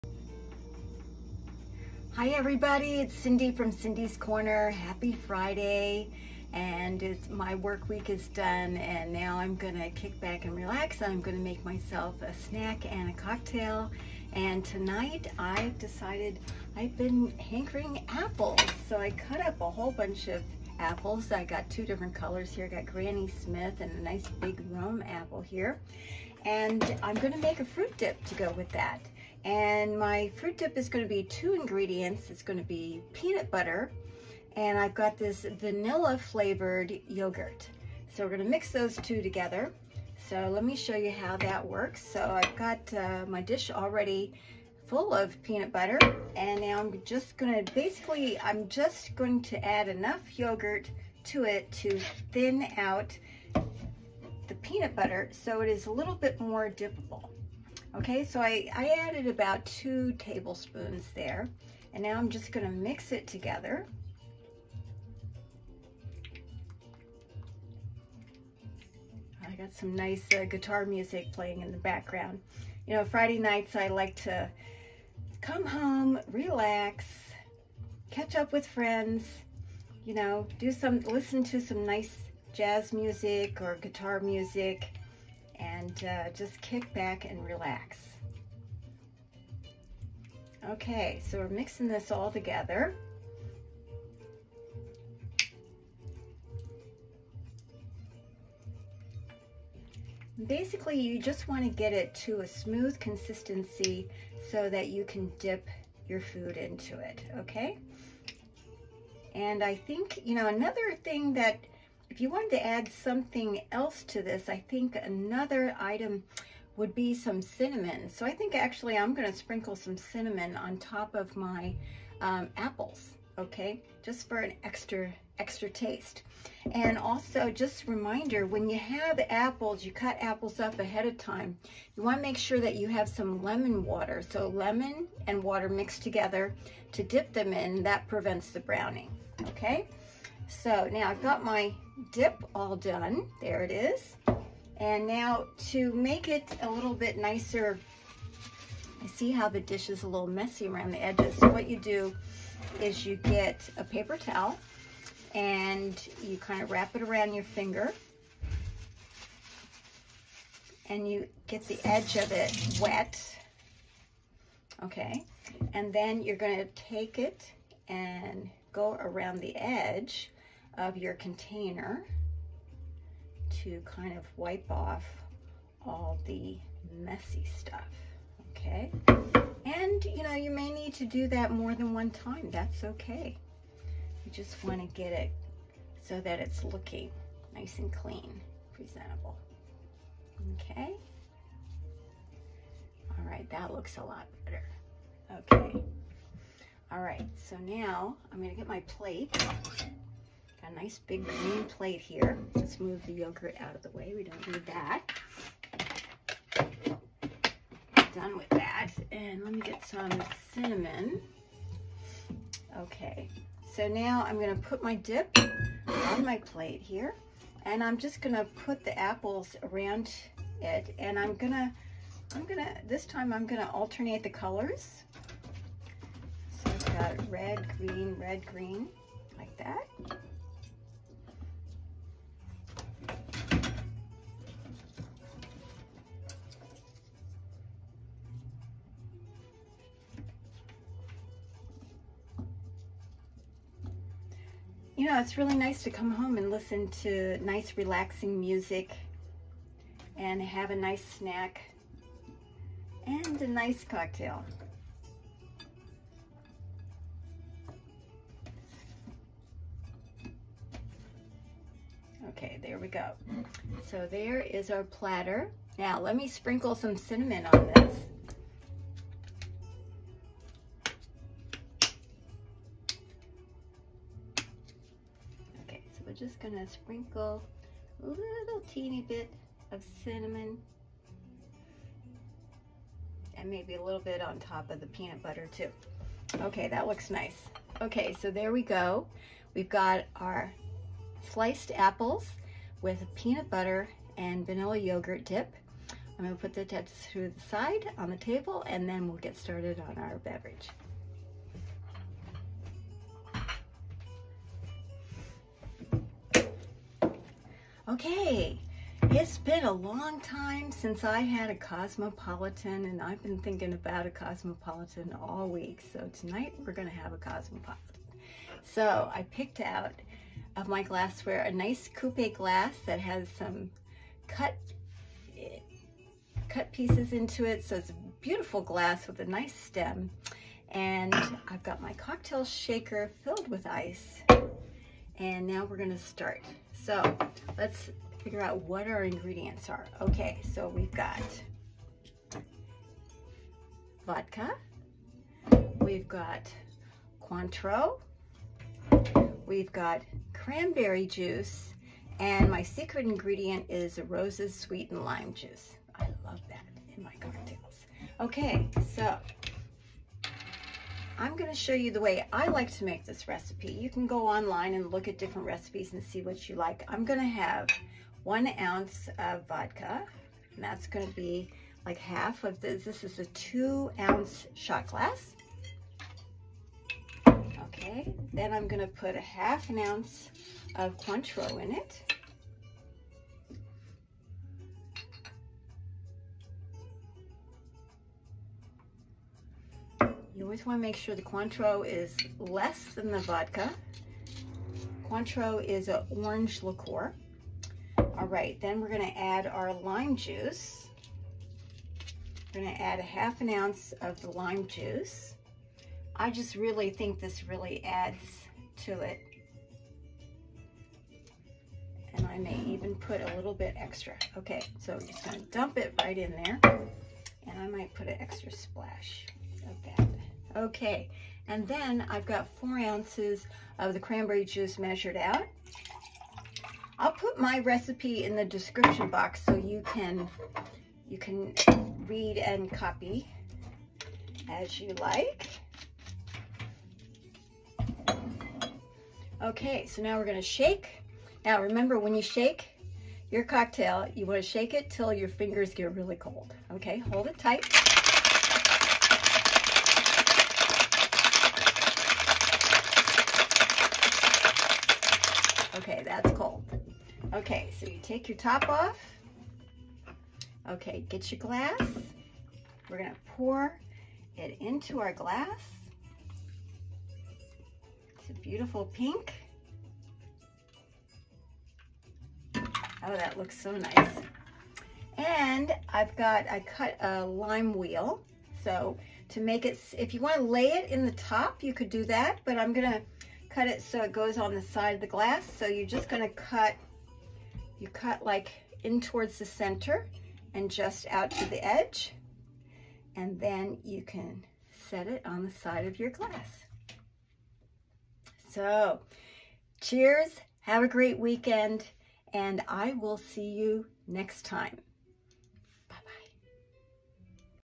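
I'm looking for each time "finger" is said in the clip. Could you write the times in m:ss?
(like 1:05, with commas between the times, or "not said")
2:37, 7:25.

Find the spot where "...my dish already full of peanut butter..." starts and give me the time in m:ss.
0:43.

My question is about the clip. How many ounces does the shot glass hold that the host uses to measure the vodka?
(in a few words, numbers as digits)
2 ounces.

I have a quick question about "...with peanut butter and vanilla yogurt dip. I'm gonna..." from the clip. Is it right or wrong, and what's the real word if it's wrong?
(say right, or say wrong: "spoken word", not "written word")
right.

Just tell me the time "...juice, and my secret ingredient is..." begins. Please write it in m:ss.
5:51.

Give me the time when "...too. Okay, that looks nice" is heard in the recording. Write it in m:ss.
4:45.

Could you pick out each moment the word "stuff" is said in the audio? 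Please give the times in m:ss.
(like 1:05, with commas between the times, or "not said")
2:57.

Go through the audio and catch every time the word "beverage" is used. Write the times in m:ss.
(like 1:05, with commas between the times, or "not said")
5:00.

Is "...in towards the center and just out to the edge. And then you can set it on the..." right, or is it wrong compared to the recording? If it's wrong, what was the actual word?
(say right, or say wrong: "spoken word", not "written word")
right.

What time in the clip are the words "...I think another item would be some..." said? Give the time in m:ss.
1:54.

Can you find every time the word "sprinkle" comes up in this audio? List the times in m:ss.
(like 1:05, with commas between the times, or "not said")
1:59, 4:26, 4:36.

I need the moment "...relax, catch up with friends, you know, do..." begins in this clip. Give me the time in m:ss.
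1:16.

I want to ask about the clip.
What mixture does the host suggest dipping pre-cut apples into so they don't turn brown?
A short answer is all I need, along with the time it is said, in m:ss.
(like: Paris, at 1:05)
Lemon water, at 2:13.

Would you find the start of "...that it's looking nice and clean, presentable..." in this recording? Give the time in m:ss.
3:06.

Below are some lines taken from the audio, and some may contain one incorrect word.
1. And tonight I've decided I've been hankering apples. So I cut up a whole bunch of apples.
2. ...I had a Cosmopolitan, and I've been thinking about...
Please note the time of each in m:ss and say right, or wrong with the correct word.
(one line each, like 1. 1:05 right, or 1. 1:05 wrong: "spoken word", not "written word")
1. 0:14 right
2. 5:11 right.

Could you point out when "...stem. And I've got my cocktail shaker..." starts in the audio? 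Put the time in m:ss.
5:29.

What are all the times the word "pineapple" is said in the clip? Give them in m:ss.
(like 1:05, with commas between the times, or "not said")
not said.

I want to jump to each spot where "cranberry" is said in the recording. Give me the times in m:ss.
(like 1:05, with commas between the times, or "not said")
5:50, 7:03.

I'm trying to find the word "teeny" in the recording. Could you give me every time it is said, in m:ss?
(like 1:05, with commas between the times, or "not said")
4:38.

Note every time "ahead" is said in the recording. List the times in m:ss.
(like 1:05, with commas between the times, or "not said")
2:10.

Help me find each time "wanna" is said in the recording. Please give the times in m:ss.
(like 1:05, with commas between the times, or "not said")
2:12, 7:24, 8:00.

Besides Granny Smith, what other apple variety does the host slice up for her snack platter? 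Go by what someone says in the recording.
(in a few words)
Rome.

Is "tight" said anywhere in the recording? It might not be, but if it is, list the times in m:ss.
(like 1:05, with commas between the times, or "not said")
7:27.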